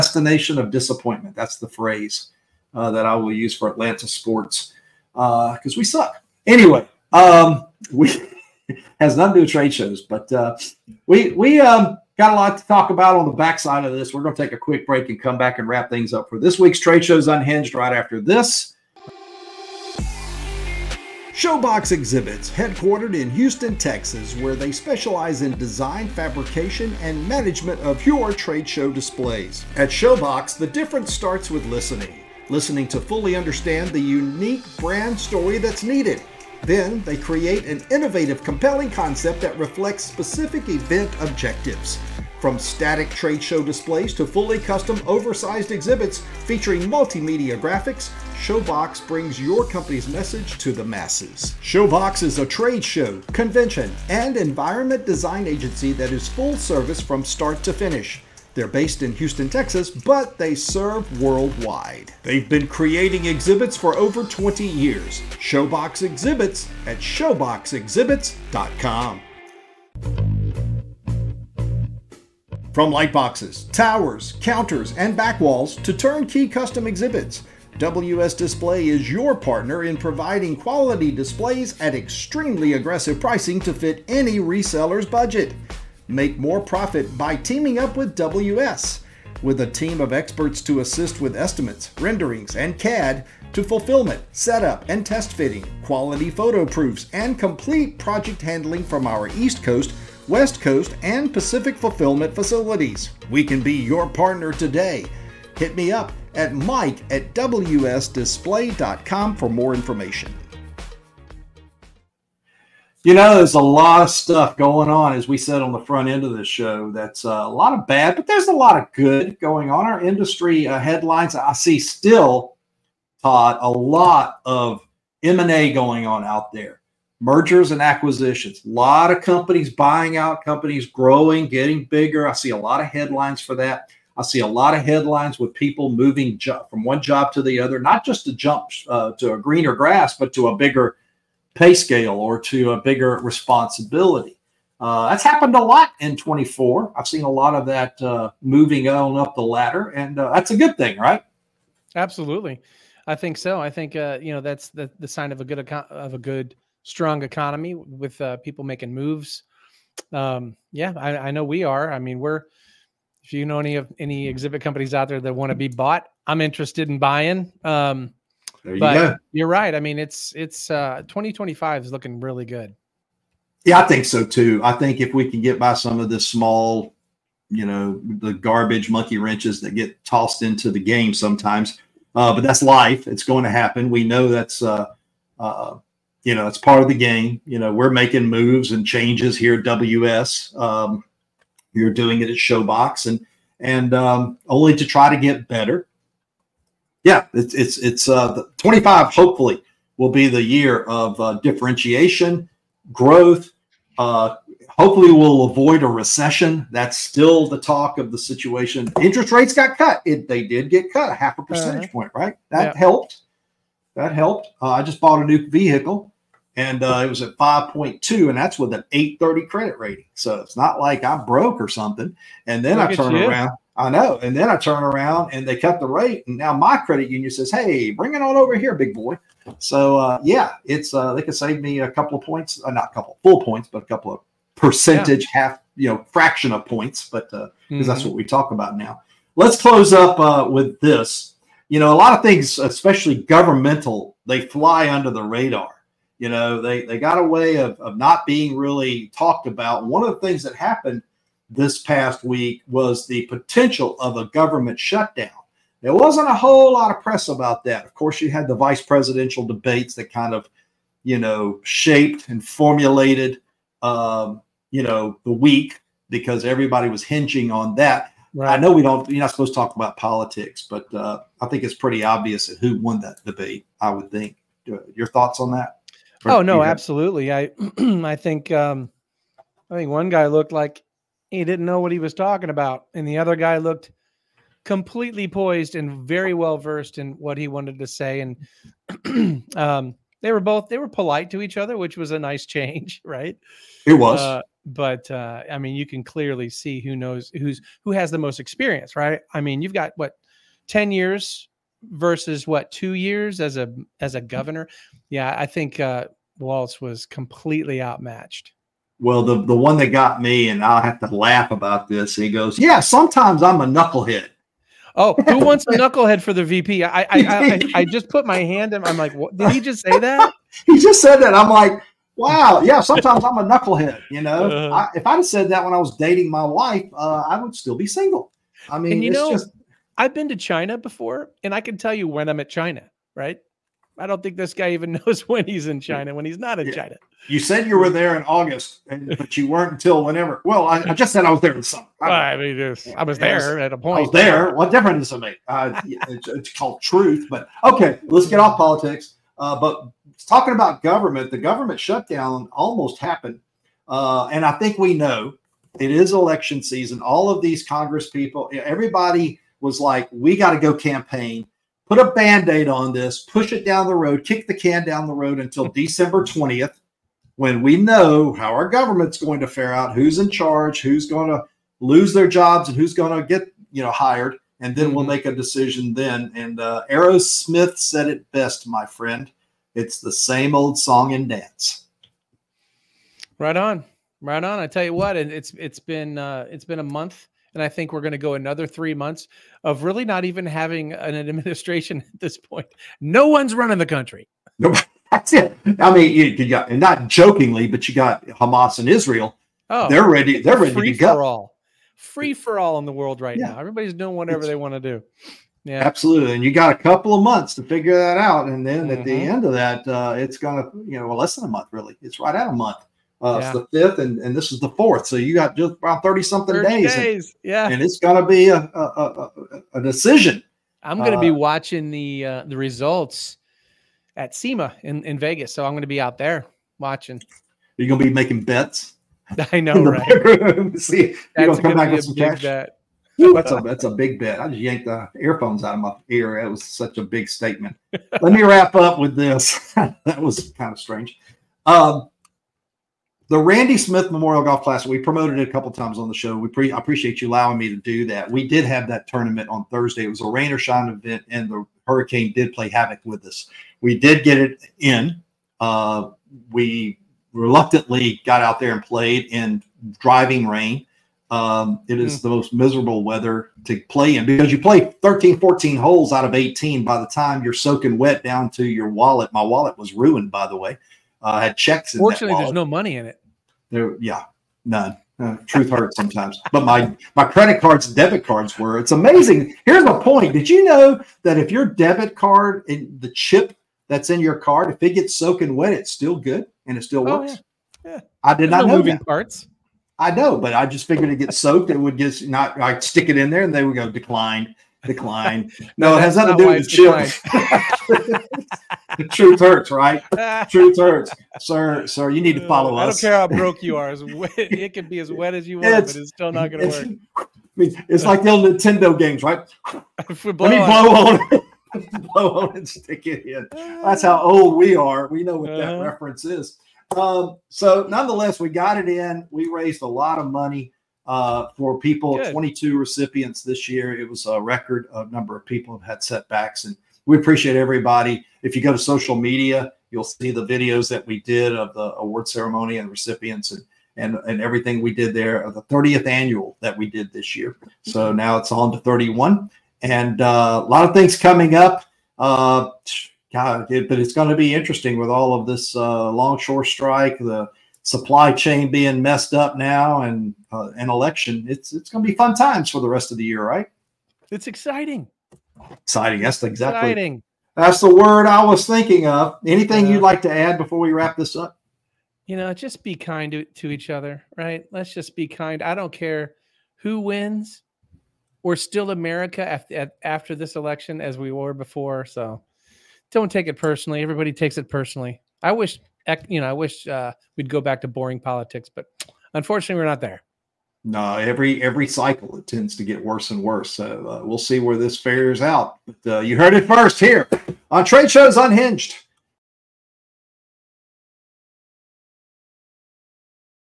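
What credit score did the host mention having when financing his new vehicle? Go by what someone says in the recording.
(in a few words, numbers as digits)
830.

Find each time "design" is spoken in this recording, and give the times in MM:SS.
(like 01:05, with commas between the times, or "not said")
00:25, 00:55.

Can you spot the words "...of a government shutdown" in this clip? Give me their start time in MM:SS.
04:14.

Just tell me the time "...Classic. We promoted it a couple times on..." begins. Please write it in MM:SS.
07:24.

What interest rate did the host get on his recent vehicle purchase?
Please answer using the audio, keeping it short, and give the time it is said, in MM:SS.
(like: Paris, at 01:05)
5.2, at 03:37.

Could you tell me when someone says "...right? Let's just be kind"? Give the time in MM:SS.
09:24.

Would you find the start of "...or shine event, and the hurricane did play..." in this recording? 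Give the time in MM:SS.
07:30.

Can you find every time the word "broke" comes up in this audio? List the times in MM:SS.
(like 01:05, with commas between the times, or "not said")
03:41, 08:23.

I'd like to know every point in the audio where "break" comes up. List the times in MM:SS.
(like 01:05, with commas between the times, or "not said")
00:14.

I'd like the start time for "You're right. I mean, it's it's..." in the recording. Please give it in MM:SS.
02:49.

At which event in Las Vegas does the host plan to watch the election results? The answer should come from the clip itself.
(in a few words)
SEMA.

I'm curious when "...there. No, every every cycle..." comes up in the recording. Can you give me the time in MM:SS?
09:40.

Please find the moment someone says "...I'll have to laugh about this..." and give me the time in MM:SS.
05:10.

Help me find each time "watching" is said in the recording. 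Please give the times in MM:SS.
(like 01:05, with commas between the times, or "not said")
07:01, 07:06.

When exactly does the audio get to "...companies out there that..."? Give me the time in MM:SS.
02:44.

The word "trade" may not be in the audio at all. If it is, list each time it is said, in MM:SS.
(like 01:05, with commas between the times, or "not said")
00:09, 00:16, 00:28, 00:43, 00:52, 09:47.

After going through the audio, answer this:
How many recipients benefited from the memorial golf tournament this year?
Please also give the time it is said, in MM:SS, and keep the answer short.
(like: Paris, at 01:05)
22, at 08:42.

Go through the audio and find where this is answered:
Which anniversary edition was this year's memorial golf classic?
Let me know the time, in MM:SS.
08:55.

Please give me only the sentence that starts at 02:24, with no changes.
Uh, that's happened a lot in 24.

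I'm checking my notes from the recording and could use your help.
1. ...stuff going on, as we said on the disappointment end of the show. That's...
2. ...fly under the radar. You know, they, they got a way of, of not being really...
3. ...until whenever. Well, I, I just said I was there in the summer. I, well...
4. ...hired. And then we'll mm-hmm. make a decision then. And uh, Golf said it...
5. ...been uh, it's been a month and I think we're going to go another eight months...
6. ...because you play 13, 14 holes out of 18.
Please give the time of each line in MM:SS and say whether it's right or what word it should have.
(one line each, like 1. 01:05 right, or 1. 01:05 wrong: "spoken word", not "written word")
1. 01:54 wrong: "front", not "disappointment"
2. 04:04 right
3. 05:39 right
4. 06:13 wrong: "Aerosmith", not "Golf"
5. 06:25 wrong: "three", not "eight"
6. 07:44 right.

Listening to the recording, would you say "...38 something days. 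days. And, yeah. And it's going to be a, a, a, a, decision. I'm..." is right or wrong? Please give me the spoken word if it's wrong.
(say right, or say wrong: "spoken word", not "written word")
wrong: "30", not "38".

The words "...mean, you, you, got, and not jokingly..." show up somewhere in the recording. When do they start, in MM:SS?
06:35.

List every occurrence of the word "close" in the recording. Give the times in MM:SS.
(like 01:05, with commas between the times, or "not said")
03:59.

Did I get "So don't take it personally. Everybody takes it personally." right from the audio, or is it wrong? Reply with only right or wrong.
right.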